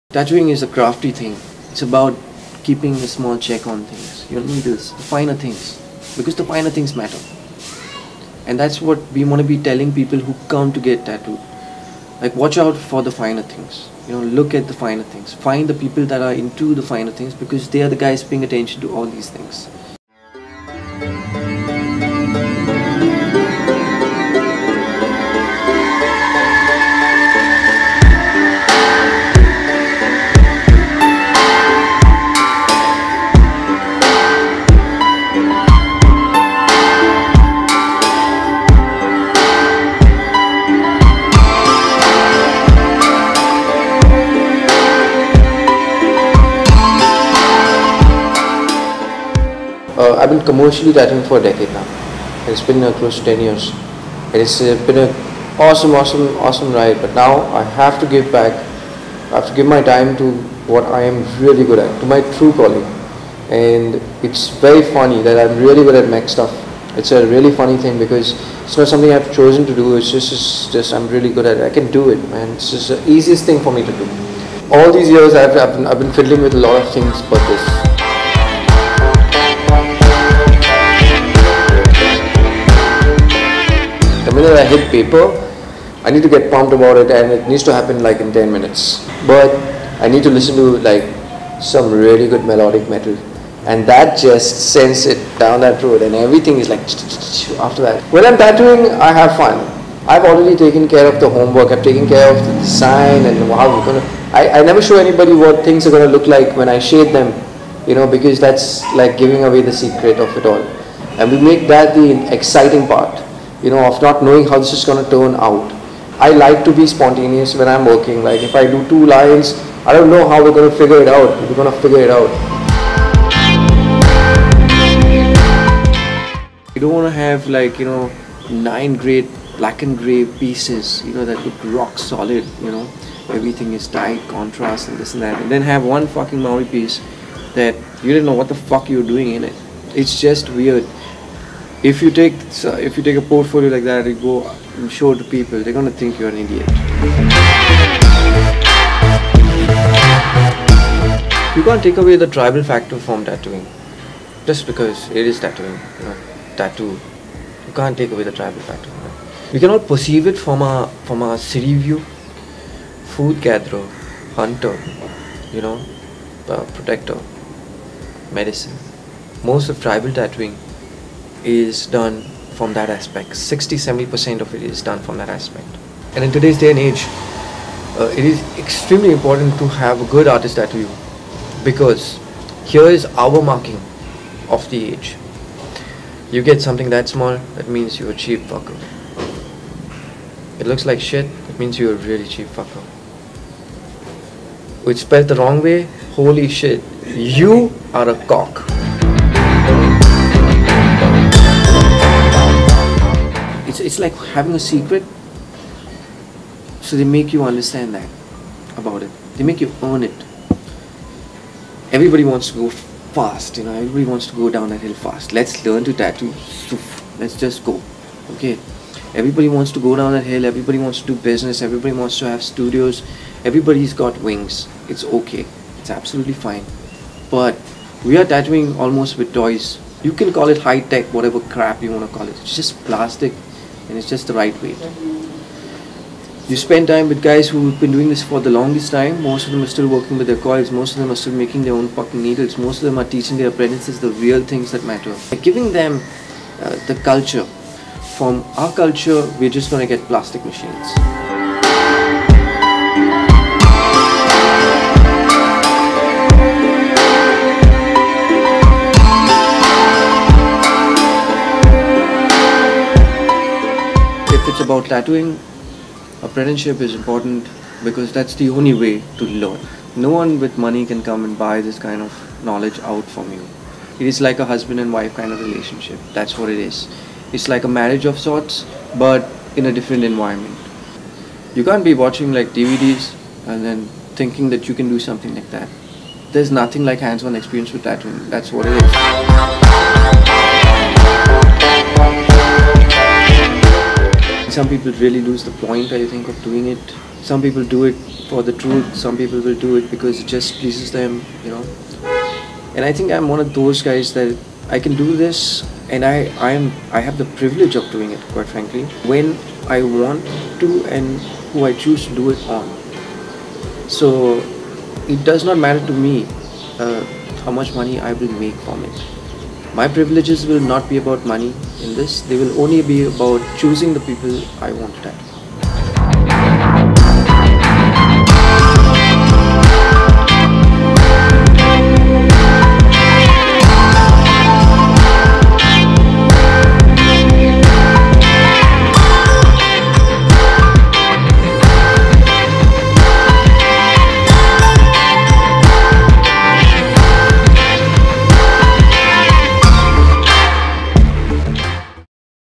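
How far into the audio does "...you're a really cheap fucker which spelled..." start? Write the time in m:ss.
3:11.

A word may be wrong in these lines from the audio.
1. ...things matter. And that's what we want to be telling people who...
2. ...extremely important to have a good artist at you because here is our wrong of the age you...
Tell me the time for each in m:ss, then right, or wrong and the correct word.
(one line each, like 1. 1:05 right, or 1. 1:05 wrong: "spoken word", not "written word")
1. 0:06 right
2. 2:58 wrong: "marking", not "wrong".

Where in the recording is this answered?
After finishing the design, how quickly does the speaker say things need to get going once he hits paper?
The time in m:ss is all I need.
1:28.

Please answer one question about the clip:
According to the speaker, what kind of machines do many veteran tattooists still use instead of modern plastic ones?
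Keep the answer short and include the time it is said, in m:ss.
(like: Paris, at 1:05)
coils, at 4:00.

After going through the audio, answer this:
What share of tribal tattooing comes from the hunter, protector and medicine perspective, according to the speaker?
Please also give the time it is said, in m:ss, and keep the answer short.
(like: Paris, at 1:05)
60-70%, at 2:53.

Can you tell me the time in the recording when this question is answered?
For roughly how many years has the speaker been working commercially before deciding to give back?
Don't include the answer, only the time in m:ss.
0:52.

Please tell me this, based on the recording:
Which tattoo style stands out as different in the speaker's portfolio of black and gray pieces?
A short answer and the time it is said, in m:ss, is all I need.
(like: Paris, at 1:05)
Maori, at 2:16.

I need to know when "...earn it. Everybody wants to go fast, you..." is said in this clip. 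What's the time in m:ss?
3:29.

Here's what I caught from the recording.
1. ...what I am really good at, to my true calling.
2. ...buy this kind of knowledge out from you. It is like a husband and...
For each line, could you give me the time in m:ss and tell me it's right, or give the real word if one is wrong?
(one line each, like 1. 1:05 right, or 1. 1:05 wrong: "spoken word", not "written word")
1. 1:00 right
2. 4:31 right.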